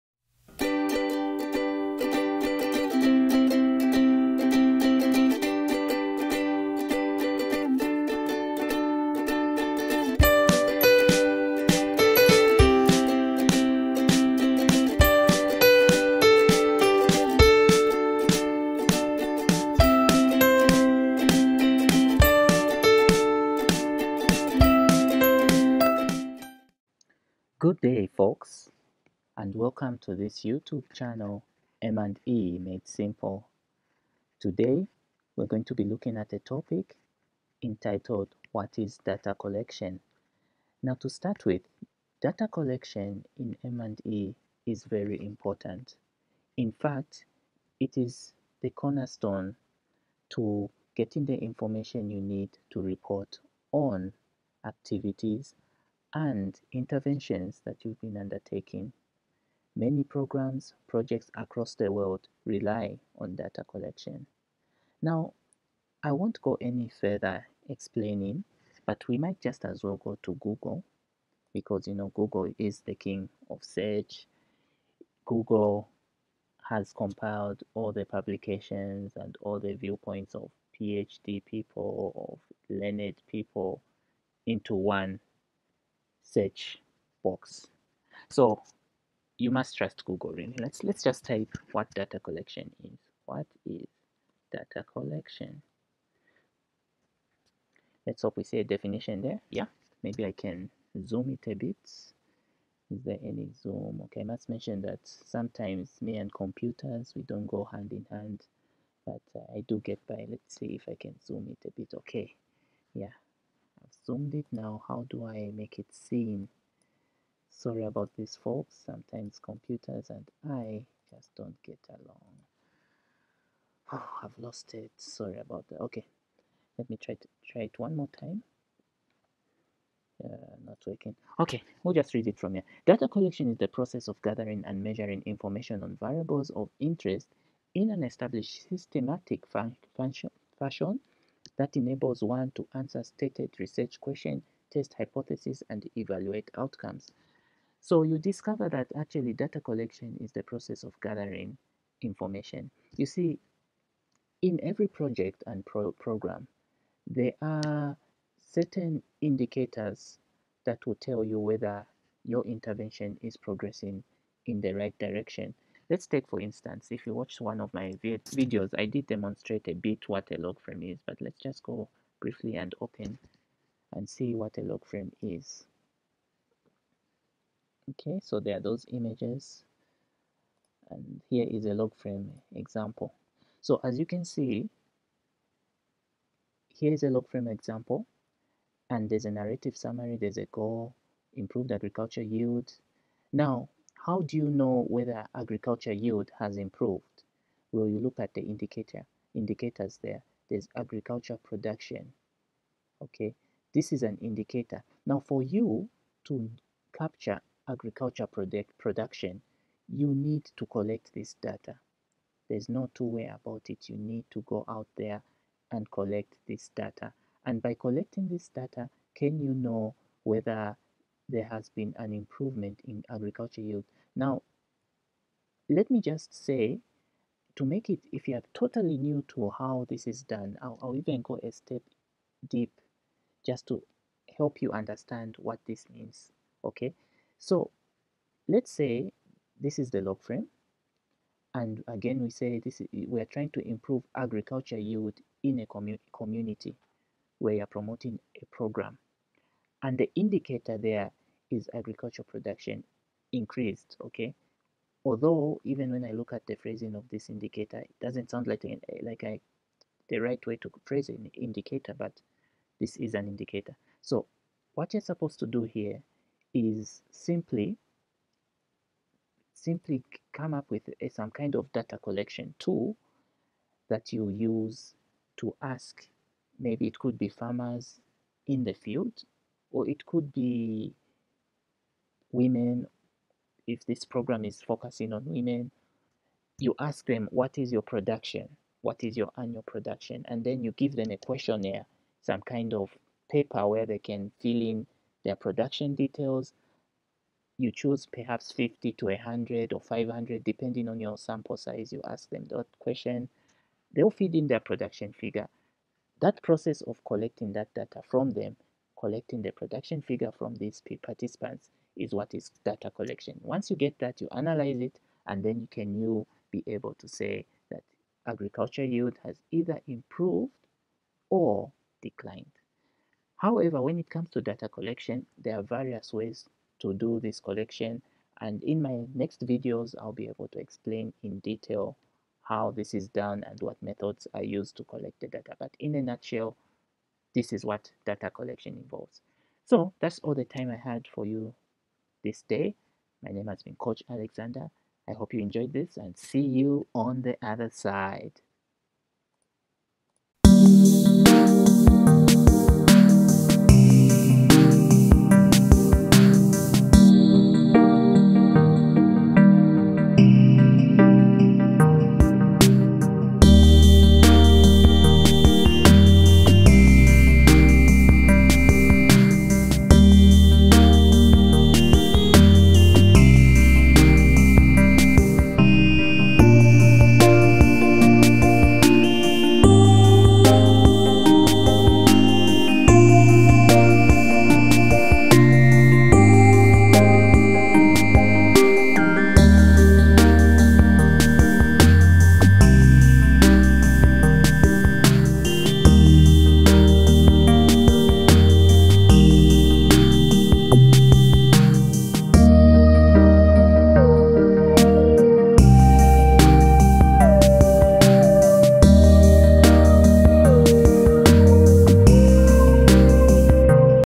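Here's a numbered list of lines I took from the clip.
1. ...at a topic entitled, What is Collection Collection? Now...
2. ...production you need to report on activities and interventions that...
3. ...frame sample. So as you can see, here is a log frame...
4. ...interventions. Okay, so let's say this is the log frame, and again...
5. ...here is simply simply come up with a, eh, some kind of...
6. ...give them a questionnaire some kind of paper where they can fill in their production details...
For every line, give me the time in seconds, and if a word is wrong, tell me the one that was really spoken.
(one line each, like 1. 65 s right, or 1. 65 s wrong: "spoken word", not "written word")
1. 36 s wrong: "Data", not "Collection"
2. 51 s wrong: "information", not "production"
3. 181 s wrong: "example", not "sample"
4. 235 s wrong: "means", not "interventions"
5. 265 s right
6. 290 s right.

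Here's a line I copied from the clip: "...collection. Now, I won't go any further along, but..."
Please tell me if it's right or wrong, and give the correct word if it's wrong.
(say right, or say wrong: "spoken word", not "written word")
wrong: "explaining", not "along".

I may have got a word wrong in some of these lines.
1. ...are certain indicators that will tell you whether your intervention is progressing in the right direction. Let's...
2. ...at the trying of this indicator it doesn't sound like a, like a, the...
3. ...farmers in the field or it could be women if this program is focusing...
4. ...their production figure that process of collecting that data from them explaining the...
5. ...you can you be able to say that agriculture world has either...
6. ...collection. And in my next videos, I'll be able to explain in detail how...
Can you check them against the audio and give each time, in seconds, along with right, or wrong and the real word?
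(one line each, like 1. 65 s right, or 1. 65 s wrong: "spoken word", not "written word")
1. 157 s right
2. 256 s wrong: "phrasing", not "trying"
3. 277 s right
4. 304 s wrong: "collecting", not "explaining"
5. 315 s wrong: "yield", not "world"
6. 327 s right.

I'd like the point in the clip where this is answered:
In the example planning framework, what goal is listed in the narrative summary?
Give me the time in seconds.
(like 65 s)
191 s.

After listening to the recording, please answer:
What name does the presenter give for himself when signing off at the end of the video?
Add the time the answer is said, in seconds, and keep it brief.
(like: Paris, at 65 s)
Coach Alexander, at 343 s.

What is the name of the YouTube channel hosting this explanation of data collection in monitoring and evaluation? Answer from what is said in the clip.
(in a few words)
M&E Made Simple.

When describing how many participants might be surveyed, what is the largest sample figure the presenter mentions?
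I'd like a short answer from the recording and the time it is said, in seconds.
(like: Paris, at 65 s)
500, at 299 s.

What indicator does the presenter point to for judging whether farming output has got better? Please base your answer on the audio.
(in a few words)
Agriculture production.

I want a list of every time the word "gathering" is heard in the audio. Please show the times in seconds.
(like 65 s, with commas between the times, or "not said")
134 s, 151 s.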